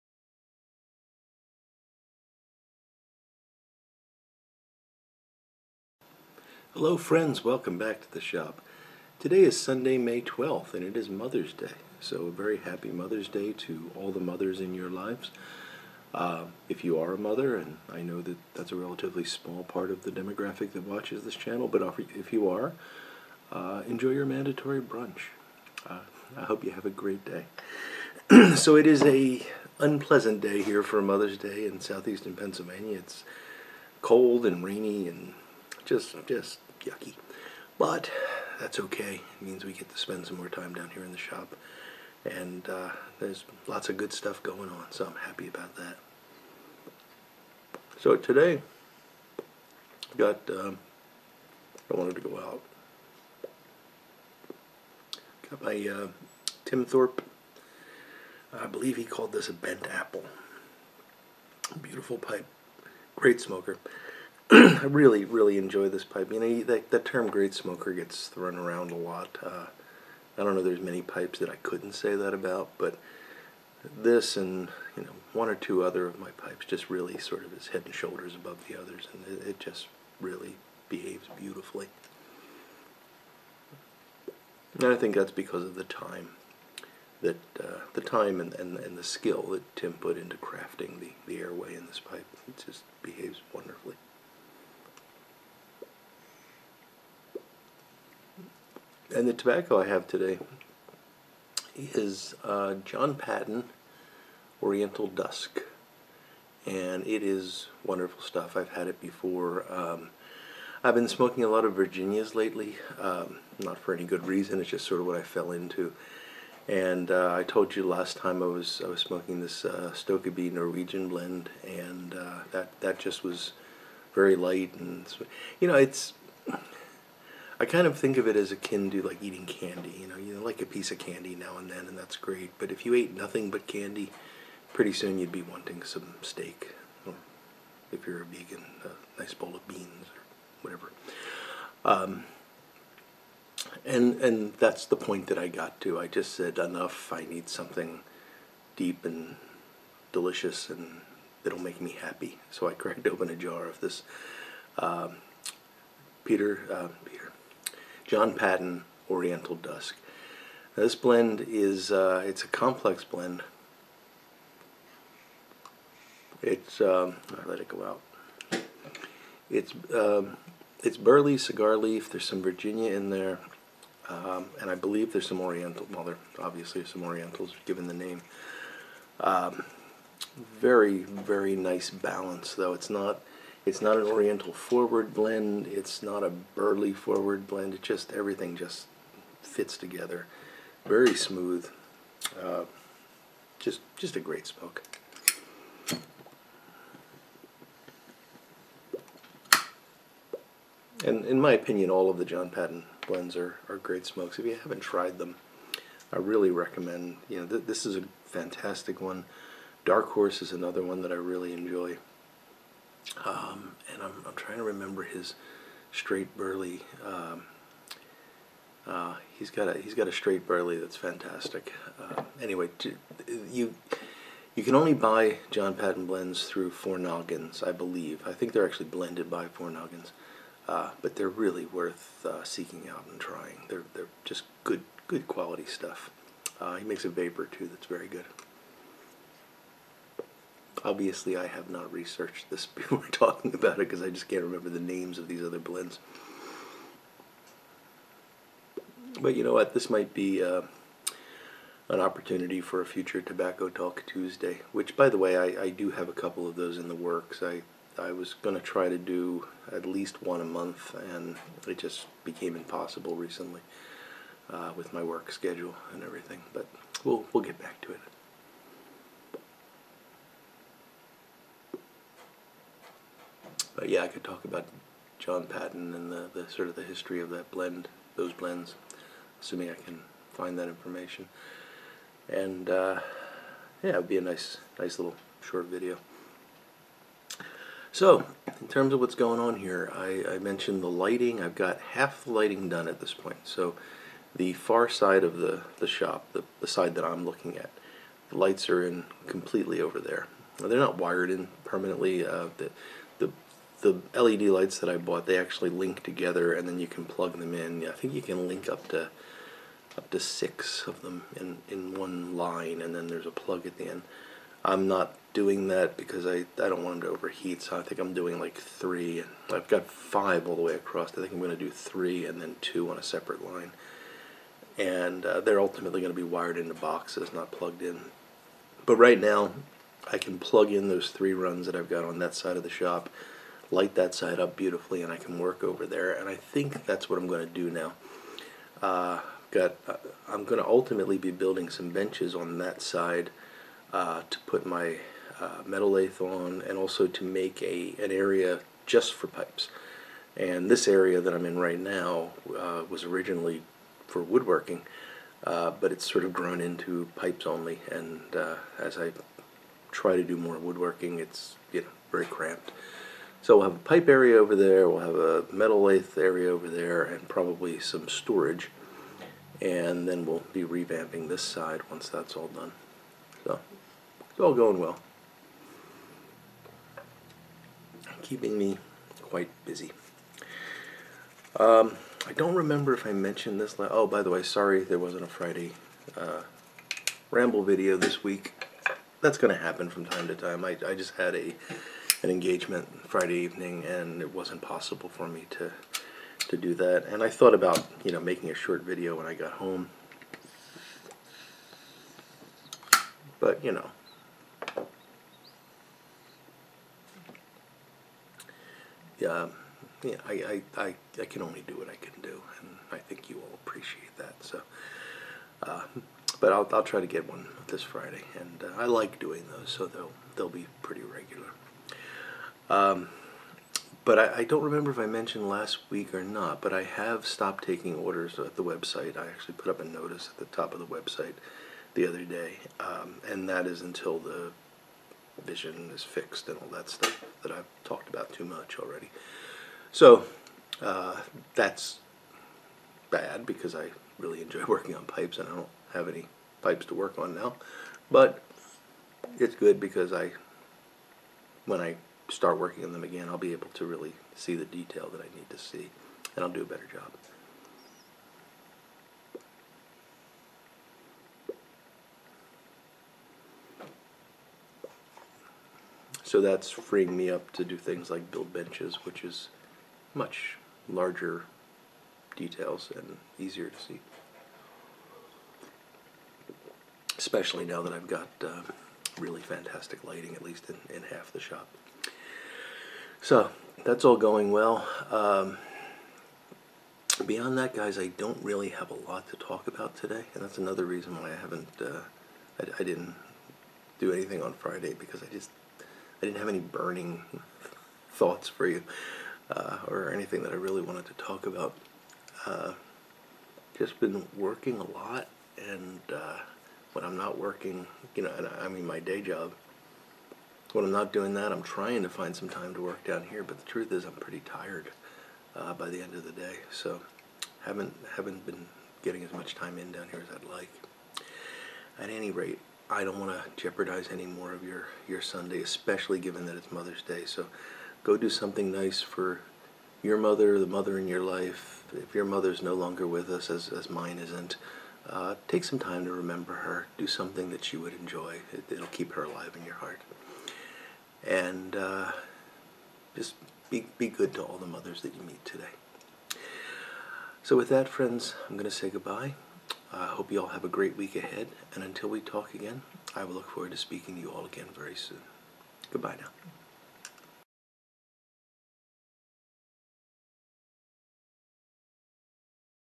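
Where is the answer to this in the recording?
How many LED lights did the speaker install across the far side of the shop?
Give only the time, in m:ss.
5:19.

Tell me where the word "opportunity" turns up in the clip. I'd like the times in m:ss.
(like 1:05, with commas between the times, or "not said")
4:11.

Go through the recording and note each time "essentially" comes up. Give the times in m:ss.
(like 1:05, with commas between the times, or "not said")
not said.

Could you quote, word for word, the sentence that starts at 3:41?
Uh, anyway, you you can only buy John Patton blends through Four Noggins, I believe.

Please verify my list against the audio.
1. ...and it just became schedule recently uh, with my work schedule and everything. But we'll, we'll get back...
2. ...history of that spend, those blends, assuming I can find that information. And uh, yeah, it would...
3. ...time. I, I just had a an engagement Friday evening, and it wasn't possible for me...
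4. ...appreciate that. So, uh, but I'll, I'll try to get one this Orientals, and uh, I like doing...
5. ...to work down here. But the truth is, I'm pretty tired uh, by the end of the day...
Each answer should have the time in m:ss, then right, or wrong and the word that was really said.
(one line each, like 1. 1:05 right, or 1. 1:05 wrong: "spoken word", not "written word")
1. 4:20 wrong: "impossible", not "schedule"
2. 4:36 wrong: "blend", not "spend"
3. 6:30 right
4. 6:53 wrong: "Friday", not "Orientals"
5. 8:32 right.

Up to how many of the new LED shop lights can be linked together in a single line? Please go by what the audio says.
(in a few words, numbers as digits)
6.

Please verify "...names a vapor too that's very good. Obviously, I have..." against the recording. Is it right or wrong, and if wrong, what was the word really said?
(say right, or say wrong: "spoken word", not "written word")
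wrong: "makes", not "names".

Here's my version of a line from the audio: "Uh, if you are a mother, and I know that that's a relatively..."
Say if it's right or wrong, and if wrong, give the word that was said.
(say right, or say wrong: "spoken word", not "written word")
right.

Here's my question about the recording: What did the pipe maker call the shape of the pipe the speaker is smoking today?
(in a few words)
Bent apple.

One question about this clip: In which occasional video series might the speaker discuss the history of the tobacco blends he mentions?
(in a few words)
Tobacco Talk Tuesday.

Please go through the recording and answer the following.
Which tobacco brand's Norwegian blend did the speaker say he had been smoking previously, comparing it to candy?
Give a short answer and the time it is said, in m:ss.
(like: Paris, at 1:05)
Stokkebye, at 1:59.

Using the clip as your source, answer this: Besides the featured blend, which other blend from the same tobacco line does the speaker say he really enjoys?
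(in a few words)
Dark Horse.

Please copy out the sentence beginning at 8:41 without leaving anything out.
At any rate, I don't want to jeopardize any more of your your Sunday, especially given that it's Mother's Day.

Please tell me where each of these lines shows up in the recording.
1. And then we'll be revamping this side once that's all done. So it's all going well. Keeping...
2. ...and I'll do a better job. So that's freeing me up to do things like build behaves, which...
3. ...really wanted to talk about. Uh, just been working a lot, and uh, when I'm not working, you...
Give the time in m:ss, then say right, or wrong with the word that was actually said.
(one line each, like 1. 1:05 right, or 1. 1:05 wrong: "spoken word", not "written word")
1. 6:09 right
2. 7:36 wrong: "benches", not "behaves"
3. 8:20 right.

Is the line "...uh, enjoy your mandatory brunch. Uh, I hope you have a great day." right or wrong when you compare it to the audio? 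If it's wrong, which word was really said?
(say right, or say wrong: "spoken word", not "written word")
right.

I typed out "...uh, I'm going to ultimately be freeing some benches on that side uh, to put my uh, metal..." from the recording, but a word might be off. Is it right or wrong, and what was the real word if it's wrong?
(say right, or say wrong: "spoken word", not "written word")
wrong: "building", not "freeing".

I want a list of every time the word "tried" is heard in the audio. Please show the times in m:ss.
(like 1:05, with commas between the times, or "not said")
3:24.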